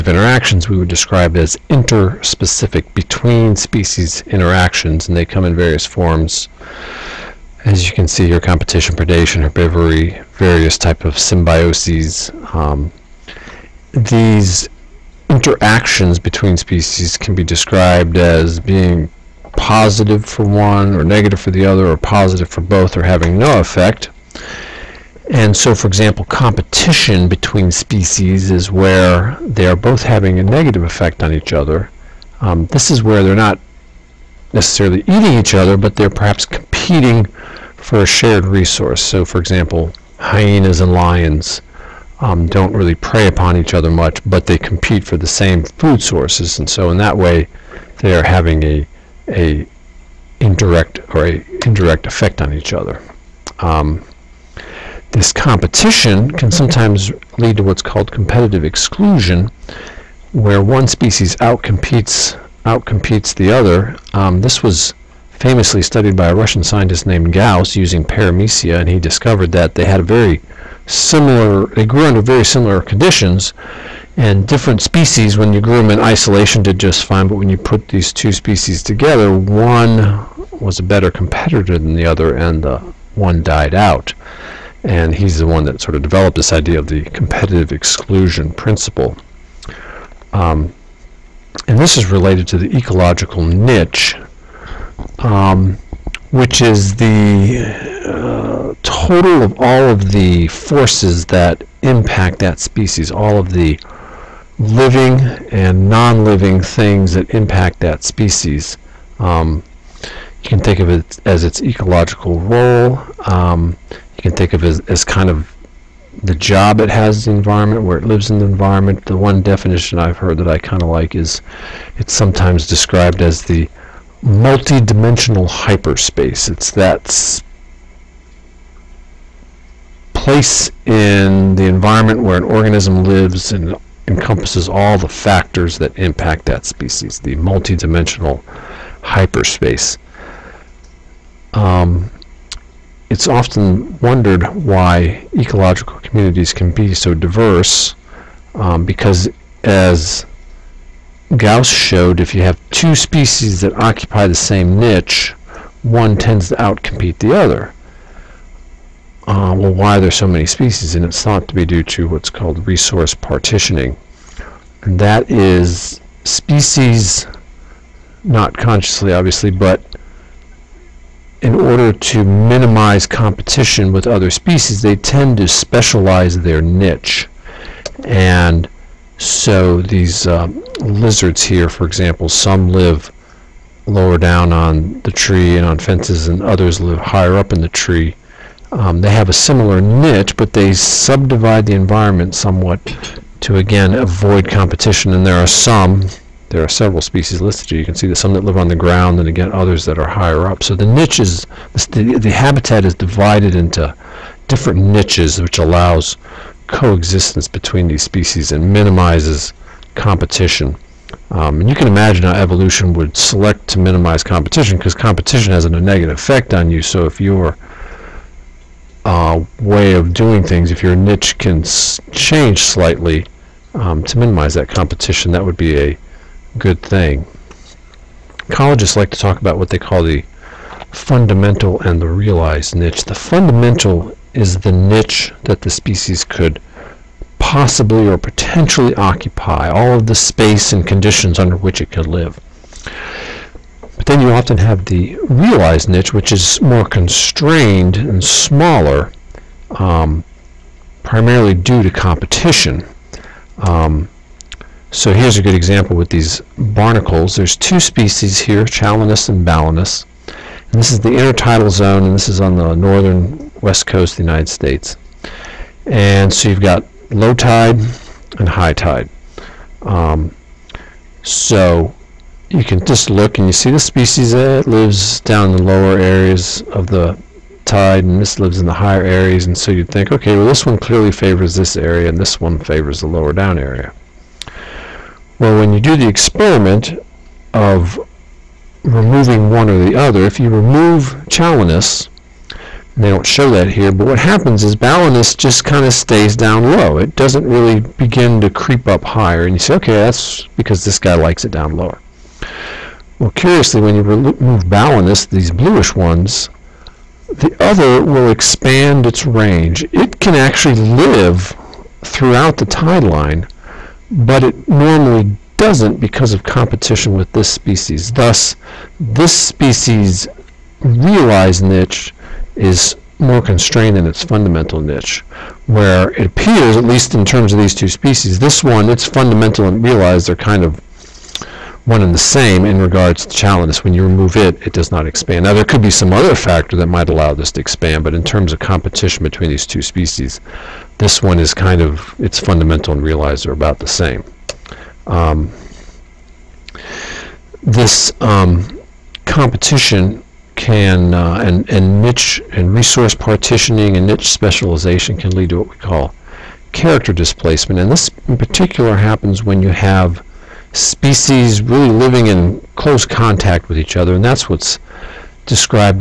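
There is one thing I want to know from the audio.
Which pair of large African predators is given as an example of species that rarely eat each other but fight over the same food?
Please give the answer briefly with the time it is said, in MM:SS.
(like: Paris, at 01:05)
Hyenas and lions, at 00:40.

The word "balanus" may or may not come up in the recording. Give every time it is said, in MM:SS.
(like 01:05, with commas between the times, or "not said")
04:19, 04:54, 05:04.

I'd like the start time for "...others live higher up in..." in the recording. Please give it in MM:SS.
03:06.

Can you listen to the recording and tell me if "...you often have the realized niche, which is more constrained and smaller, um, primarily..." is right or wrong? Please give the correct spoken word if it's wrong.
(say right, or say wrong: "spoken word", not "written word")
right.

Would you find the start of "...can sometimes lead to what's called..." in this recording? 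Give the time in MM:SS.
00:56.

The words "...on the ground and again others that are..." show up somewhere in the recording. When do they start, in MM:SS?
03:18.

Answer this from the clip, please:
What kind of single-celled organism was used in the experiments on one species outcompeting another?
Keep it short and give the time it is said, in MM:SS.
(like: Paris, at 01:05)
Paramecia, at 01:08.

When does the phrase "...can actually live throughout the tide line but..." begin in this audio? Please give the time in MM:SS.
05:10.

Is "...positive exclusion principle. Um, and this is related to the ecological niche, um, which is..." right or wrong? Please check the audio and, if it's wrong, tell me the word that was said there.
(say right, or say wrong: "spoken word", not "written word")
wrong: "competitive", not "positive".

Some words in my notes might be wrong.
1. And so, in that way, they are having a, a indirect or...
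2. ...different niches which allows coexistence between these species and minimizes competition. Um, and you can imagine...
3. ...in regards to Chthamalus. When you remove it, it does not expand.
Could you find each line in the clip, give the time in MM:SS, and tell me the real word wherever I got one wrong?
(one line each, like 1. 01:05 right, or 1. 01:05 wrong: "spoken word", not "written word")
1. 00:46 right
2. 03:24 right
3. 05:32 right.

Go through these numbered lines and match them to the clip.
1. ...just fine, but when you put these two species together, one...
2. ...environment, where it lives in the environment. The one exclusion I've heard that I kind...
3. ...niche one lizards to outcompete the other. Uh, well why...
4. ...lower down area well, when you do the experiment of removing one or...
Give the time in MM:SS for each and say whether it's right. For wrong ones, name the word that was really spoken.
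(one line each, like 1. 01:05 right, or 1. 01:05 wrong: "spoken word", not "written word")
1. 01:16 right
2. 01:57 wrong: "definition", not "exclusion"
3. 02:34 wrong: "tends", not "lizards"
4. 04:43 right.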